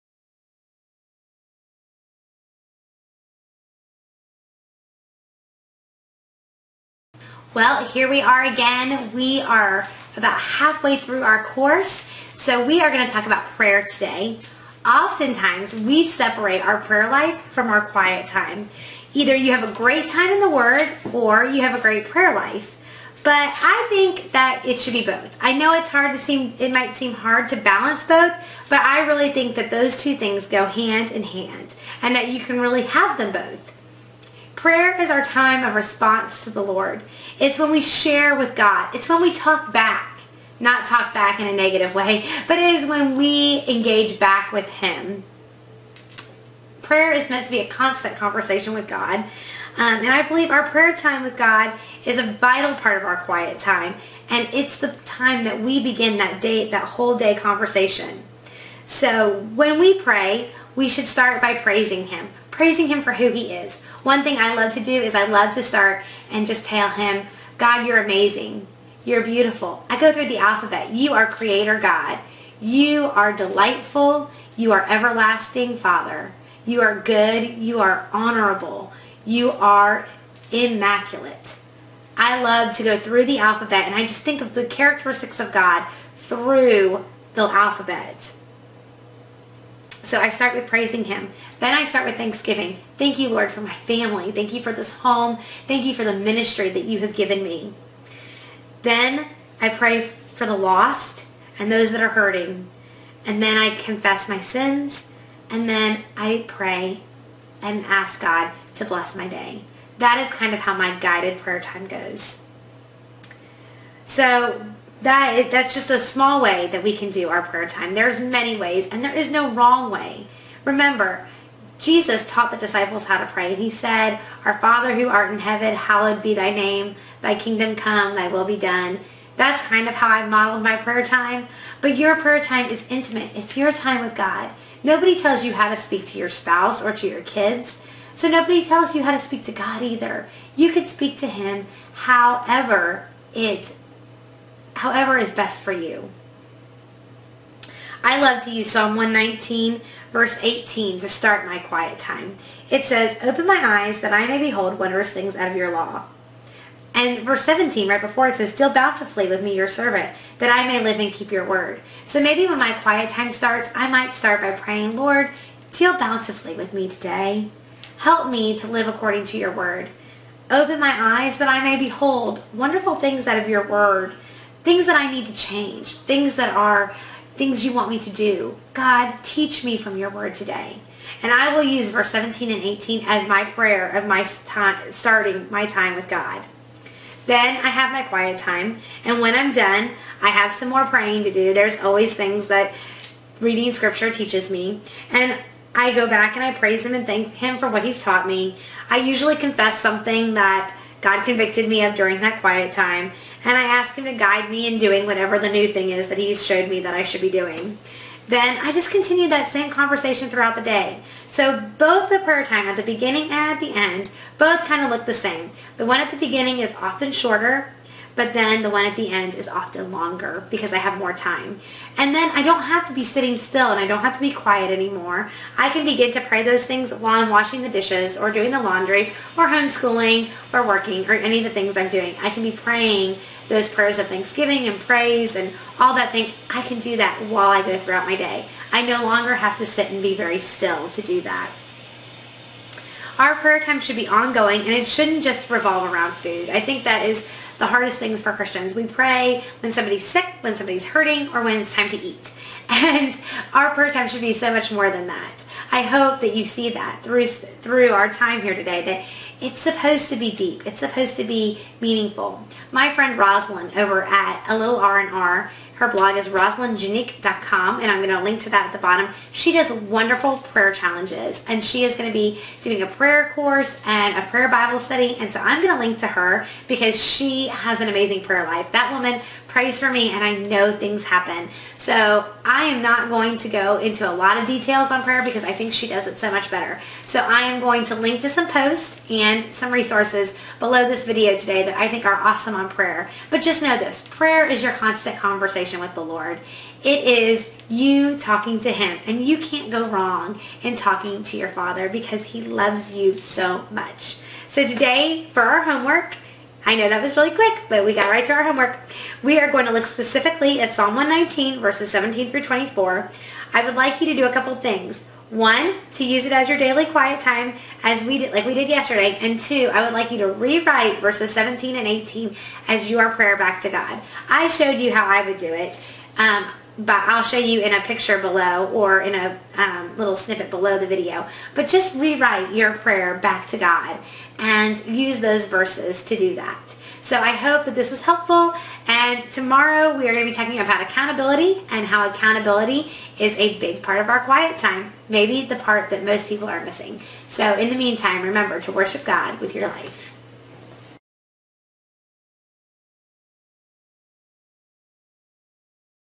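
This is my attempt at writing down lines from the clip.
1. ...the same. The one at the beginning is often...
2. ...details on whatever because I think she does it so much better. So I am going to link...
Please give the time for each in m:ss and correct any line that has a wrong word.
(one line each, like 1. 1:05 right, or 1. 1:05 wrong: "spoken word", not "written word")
1. 3:35 right
2. 4:44 wrong: "prayer", not "whatever".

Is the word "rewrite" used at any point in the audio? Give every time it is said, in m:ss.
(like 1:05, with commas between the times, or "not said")
5:20, 5:31.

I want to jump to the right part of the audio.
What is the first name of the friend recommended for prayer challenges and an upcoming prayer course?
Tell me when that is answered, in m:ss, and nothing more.
4:23.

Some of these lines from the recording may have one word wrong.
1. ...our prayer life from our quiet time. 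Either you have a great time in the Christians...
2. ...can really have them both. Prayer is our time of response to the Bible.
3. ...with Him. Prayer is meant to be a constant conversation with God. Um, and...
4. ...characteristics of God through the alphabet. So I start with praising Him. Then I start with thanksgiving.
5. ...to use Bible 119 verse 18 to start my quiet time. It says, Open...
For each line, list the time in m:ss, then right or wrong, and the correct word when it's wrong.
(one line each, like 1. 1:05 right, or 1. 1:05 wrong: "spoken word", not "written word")
1. 0:16 wrong: "Word", not "Christians"
2. 0:32 wrong: "Lord", not "Bible"
3. 0:44 right
4. 1:24 right
5. 2:28 wrong: "Psalm", not "Bible".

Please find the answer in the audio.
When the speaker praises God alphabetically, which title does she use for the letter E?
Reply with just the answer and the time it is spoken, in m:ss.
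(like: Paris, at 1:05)
Everlasting Father, at 1:14.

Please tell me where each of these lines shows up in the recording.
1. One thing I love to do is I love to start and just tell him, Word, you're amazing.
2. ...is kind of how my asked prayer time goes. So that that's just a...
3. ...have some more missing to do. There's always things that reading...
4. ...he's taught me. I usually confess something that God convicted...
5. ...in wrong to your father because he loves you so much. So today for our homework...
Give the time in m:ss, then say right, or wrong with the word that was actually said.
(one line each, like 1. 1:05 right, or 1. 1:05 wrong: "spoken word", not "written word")
1. 1:04 wrong: "God", not "Word"
2. 1:50 wrong: "guided", not "asked"
3. 3:10 wrong: "praying", not "missing"
4. 3:17 right
5. 5:00 wrong: "talking", not "wrong".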